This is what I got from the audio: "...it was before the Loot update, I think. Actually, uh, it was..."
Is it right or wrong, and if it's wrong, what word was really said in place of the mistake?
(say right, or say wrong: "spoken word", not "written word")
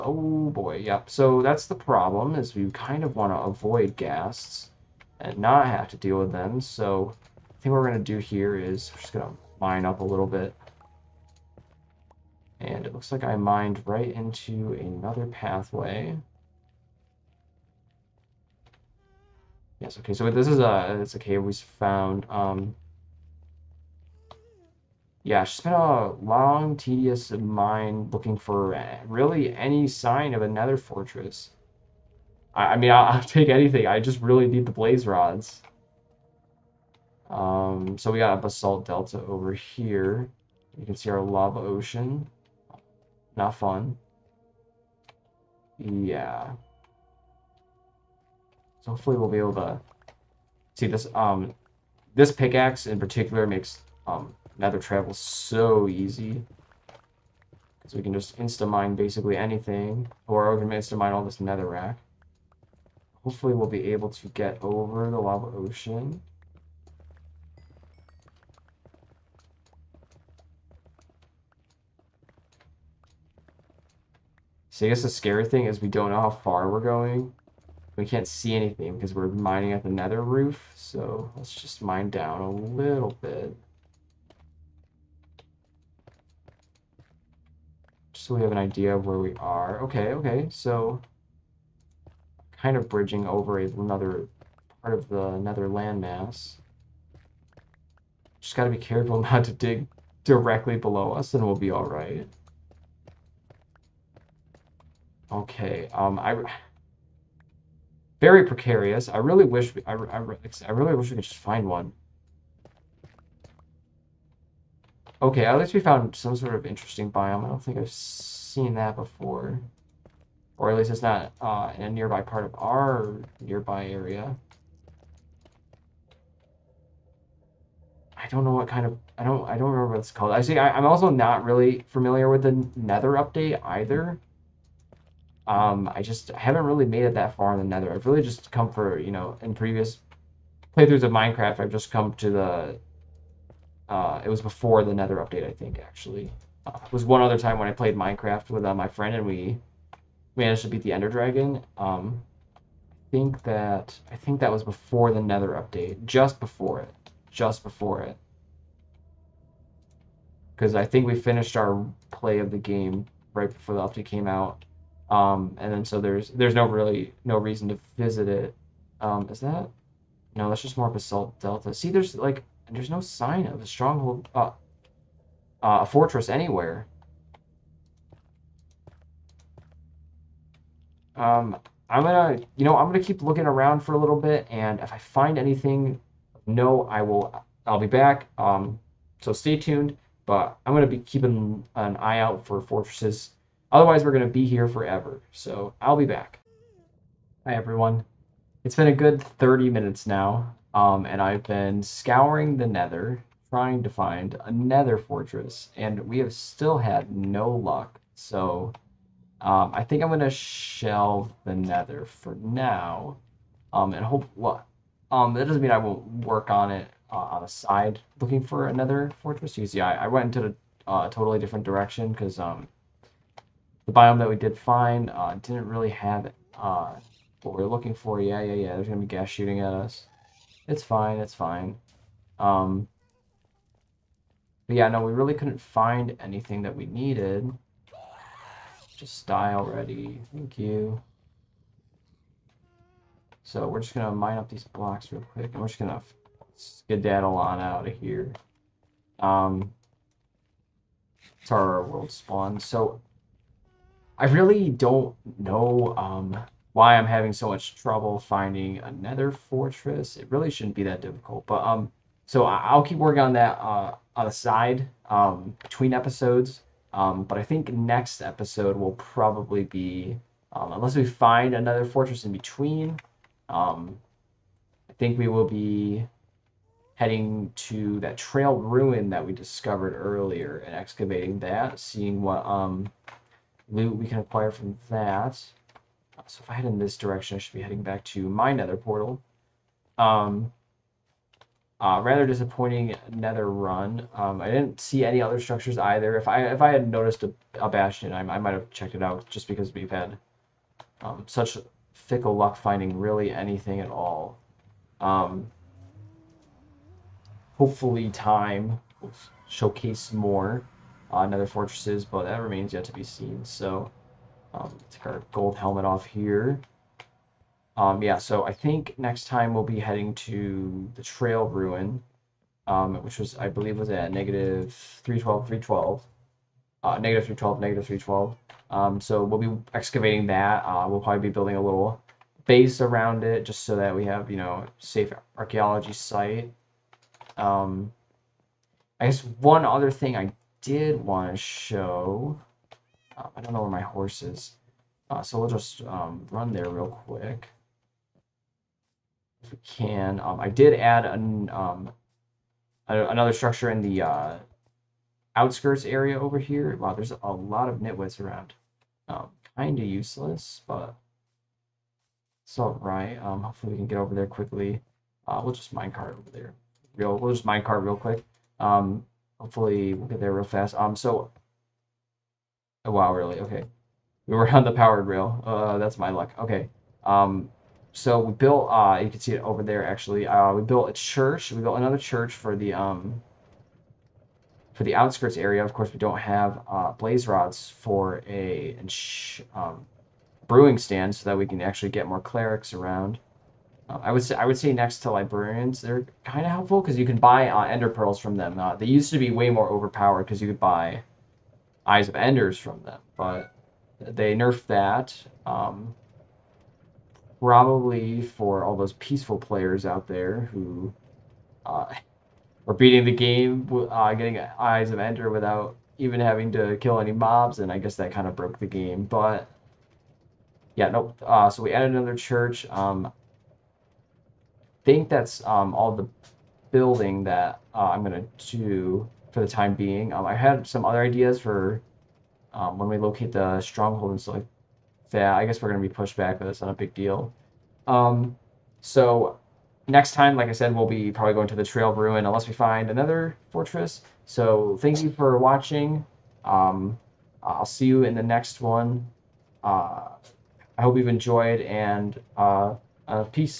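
wrong: "Nether", not "Loot".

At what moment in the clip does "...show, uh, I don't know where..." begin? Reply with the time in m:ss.
5:41.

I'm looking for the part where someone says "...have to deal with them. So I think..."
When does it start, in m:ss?
0:05.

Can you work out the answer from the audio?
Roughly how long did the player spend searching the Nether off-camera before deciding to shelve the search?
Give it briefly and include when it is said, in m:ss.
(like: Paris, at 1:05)
30 minutes, at 3:19.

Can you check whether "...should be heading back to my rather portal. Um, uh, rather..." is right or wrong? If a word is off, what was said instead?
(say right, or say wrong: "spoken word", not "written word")
wrong: "nether", not "rather".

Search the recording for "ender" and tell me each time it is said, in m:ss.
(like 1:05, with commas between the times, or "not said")
2:30, 6:37, 6:42, 6:54.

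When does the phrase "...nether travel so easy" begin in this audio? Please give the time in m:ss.
0:54.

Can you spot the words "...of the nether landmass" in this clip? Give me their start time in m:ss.
1:34.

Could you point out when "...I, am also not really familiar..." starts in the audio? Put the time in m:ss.
2:10.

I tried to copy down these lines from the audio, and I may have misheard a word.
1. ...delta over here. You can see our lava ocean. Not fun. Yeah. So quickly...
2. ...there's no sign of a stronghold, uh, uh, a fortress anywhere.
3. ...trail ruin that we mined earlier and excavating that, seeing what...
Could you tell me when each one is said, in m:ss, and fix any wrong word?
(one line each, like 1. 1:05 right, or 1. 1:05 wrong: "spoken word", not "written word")
1. 0:38 wrong: "hopefully", not "quickly"
2. 2:52 right
3. 4:38 wrong: "discovered", not "mined".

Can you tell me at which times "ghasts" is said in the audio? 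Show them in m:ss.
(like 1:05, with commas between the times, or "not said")
0:03, 3:49.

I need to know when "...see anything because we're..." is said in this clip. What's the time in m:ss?
1:18.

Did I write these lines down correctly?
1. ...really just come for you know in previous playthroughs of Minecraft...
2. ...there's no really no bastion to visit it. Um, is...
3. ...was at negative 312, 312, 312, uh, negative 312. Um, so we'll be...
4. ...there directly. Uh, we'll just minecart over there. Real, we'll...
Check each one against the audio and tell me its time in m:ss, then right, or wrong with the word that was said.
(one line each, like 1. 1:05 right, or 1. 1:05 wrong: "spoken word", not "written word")
1. 2:18 right
2. 2:46 wrong: "reason", not "bastion"
3. 5:23 right
4. 6:04 wrong: "quickly", not "directly".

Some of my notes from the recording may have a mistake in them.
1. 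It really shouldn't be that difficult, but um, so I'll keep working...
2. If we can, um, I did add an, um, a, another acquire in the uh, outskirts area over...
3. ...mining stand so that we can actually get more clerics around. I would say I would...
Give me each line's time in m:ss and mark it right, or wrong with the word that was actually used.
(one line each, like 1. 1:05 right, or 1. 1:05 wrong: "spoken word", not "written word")
1. 4:20 right
2. 5:49 wrong: "structure", not "acquire"
3. 6:30 wrong: "brewing", not "mining".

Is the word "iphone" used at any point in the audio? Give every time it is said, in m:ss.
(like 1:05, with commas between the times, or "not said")
not said.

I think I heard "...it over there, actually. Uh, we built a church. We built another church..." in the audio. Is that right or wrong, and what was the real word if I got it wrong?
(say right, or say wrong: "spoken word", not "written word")
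right.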